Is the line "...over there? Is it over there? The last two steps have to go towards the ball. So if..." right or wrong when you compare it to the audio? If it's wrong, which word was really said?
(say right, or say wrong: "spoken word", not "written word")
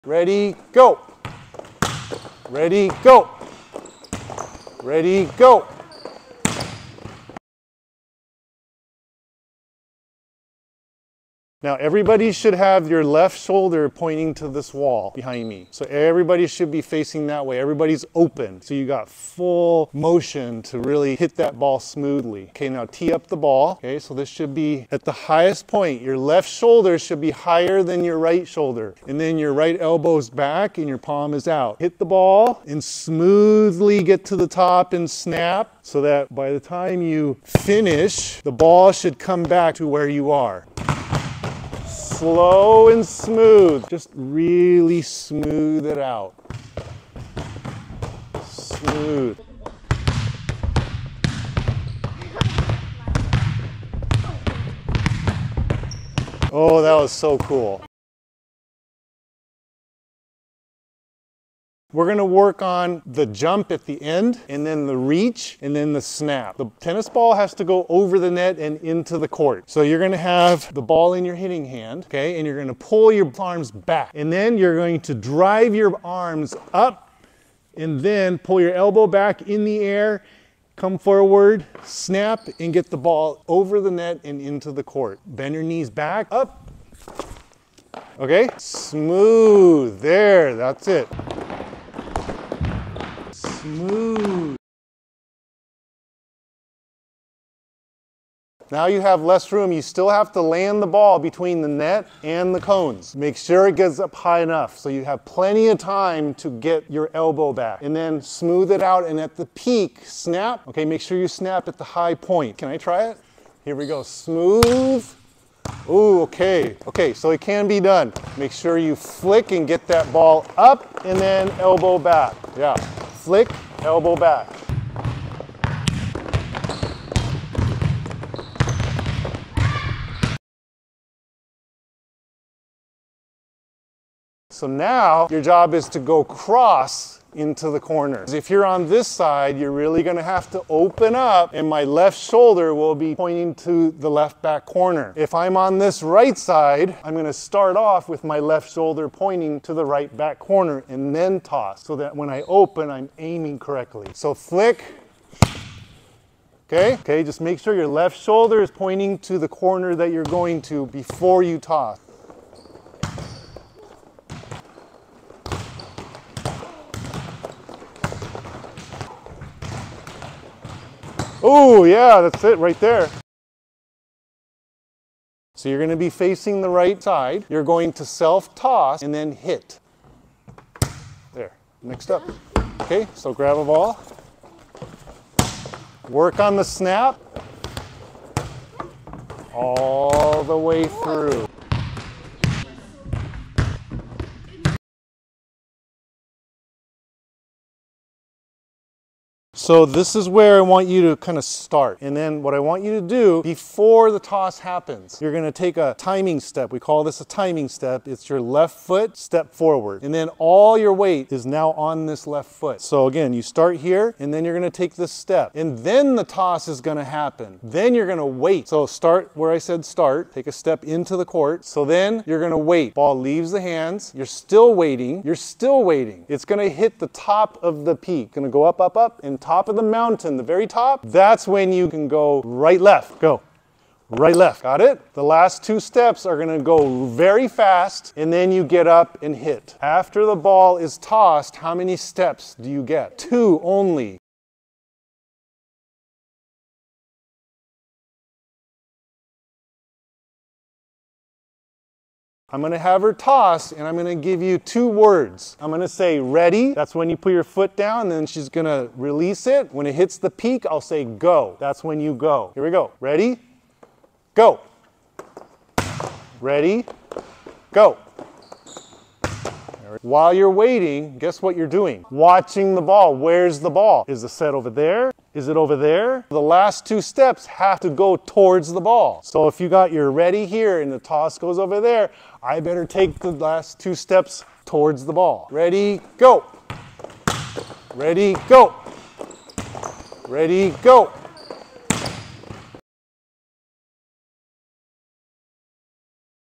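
right.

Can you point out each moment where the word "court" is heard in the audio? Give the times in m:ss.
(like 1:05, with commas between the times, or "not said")
1:09, 1:24, 3:41.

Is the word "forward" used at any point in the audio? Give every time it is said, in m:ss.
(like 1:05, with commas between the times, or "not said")
1:20, 3:29.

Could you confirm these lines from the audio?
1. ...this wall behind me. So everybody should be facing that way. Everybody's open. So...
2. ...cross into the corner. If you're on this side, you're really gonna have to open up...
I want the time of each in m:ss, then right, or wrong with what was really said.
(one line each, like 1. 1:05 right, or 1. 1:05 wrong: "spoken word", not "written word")
1. 0:14 right
2. 2:16 right.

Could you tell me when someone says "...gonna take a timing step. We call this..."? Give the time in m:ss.
3:25.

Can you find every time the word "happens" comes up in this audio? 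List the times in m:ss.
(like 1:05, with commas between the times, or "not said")
3:24, 3:37.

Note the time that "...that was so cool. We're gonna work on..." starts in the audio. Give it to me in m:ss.
0:56.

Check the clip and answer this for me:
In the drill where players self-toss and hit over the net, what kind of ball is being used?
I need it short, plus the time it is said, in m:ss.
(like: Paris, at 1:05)
Tennis ball, at 1:06.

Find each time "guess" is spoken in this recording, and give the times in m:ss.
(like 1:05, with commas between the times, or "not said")
4:31.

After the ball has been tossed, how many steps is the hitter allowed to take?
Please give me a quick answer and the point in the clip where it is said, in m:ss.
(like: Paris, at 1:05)
2, at 4:03.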